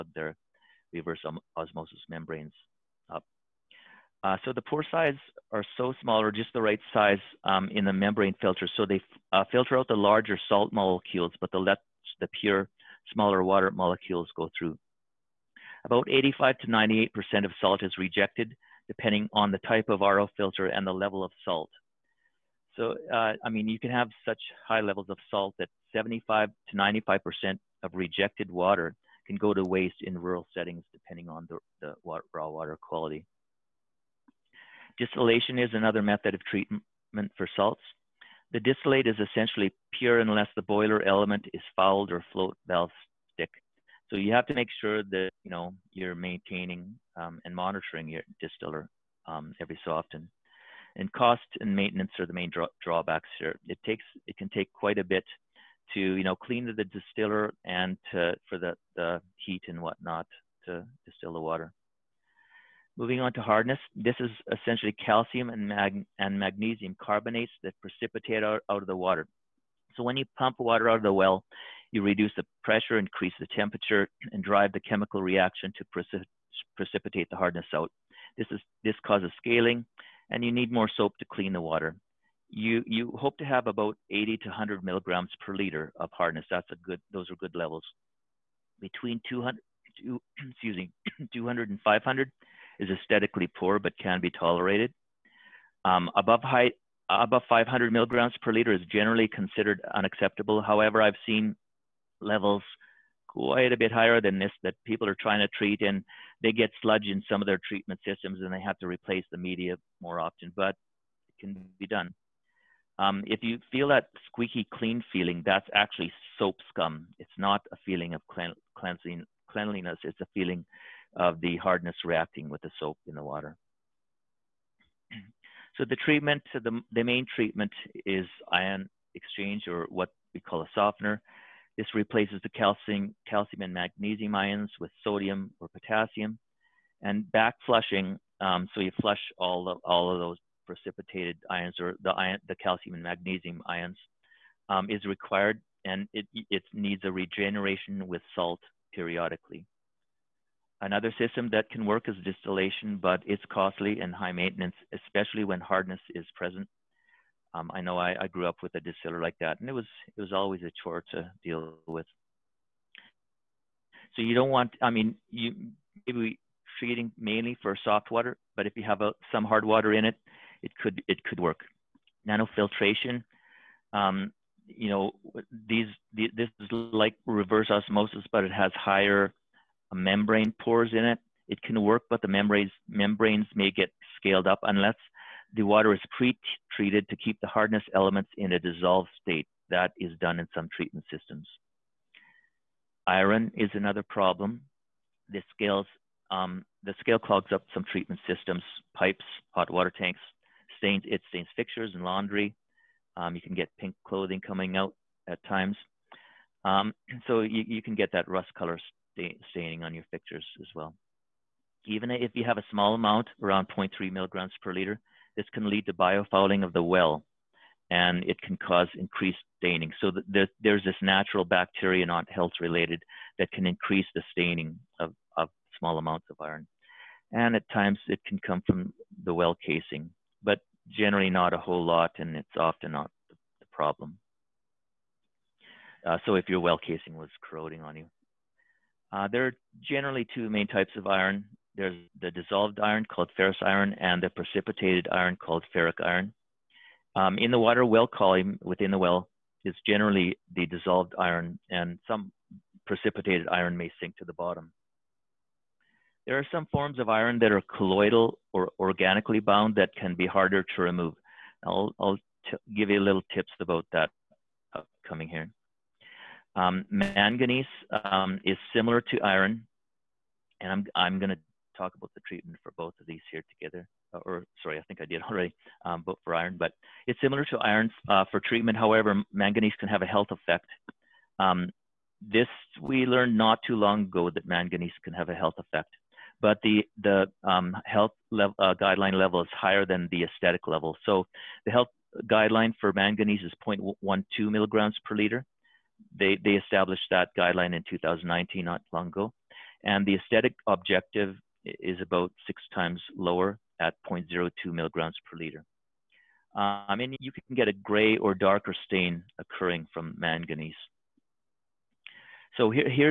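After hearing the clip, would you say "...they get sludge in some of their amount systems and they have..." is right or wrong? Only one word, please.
wrong.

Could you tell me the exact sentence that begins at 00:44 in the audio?
So you have to make sure that you know you're maintaining um, and monitoring your distiller um, every so often.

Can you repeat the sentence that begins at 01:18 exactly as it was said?
This, is, this causes scaling, and you need more soap to clean the water.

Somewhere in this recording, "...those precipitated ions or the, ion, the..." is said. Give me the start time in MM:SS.
02:20.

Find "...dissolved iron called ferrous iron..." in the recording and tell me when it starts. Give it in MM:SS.
04:02.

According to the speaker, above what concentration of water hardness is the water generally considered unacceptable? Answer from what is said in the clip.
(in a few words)
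500 mg/L.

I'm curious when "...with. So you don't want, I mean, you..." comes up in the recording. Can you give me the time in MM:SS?
02:41.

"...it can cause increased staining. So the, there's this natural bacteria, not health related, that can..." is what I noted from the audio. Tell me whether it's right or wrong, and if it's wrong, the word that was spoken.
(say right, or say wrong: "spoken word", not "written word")
right.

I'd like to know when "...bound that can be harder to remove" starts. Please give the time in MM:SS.
04:19.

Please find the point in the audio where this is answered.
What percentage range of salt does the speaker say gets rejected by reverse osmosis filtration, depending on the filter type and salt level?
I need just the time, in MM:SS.
00:16.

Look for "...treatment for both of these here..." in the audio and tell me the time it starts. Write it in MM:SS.
04:32.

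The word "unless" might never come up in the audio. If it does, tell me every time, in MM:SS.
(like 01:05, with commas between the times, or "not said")
00:40, 03:04.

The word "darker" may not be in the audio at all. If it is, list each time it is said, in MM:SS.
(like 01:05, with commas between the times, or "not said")
05:08.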